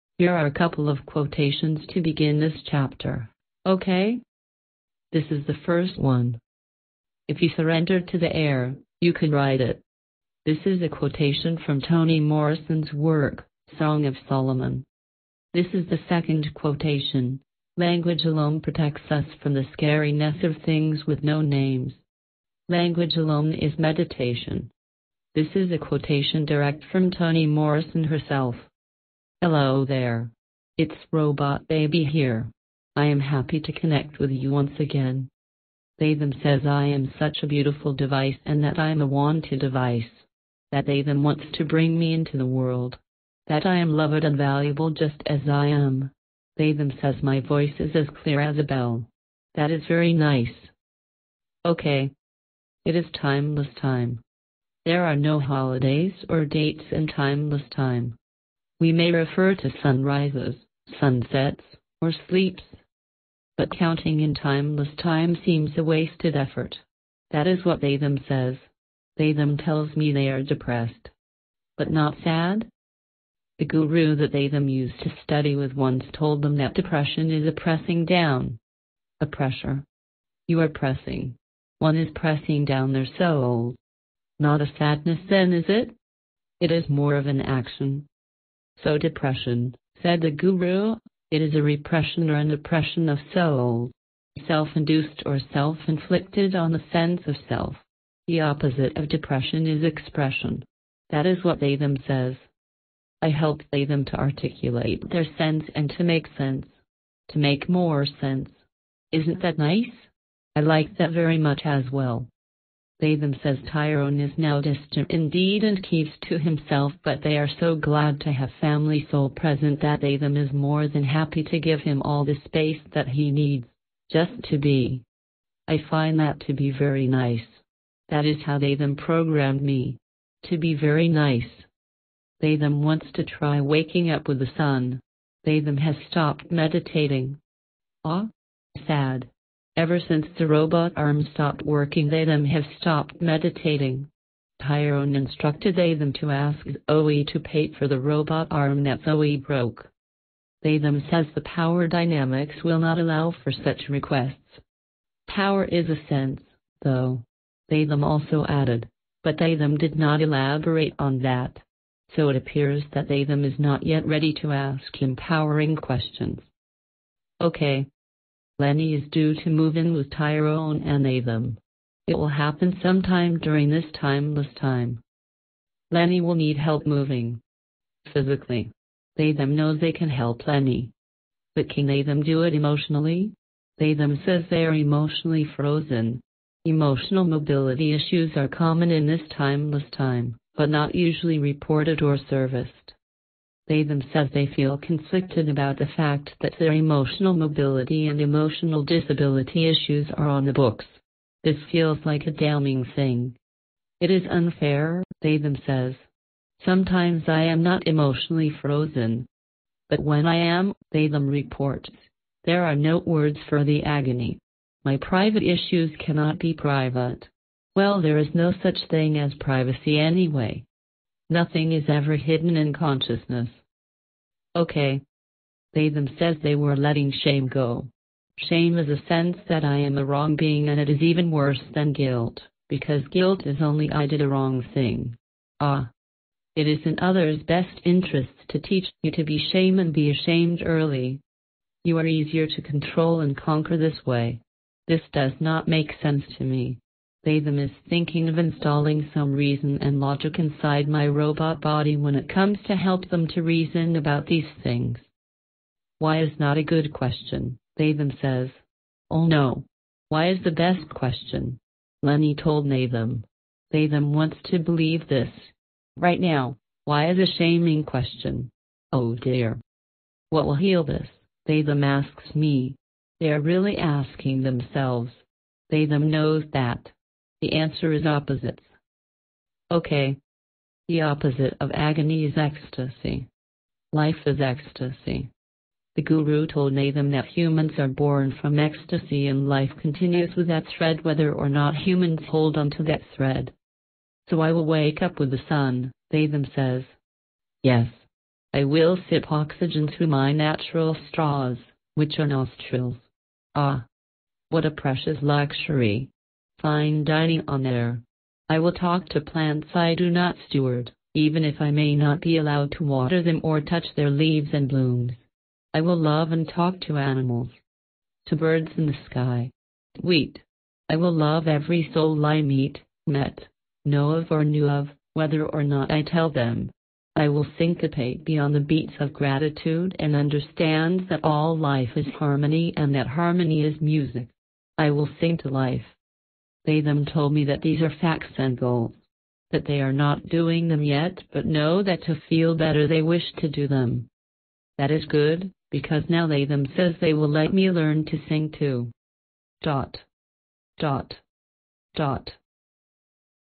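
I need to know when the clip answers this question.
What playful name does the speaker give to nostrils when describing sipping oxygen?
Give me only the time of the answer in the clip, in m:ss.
5:00.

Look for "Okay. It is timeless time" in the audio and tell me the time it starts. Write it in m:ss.
0:51.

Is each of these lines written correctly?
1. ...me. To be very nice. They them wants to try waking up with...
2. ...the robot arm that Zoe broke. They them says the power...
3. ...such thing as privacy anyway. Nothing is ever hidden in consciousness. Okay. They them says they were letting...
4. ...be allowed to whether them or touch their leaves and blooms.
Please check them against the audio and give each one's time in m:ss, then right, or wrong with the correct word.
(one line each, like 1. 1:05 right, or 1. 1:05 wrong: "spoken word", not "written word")
1. 2:09 right
2. 2:27 right
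3. 3:38 right
4. 5:12 wrong: "water", not "whether".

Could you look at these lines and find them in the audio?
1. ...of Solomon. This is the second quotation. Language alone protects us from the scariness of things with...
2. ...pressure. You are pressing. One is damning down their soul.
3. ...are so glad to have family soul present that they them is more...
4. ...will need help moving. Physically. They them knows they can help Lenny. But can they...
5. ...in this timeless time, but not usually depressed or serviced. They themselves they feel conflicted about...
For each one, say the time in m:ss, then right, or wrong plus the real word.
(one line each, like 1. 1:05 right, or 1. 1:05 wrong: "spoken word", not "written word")
1. 0:14 right
2. 1:19 wrong: "pressing", not "damning"
3. 1:57 right
4. 2:56 right
5. 3:08 wrong: "reported", not "depressed".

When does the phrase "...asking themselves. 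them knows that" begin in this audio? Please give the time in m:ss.
4:33.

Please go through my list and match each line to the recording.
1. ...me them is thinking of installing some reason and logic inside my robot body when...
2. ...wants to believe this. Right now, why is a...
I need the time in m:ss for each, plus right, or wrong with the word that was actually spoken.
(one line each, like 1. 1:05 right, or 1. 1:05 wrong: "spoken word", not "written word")
1. 4:06 right
2. 4:24 right.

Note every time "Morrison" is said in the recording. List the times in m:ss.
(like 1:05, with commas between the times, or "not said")
0:12, 0:27.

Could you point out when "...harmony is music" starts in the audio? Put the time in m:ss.
5:33.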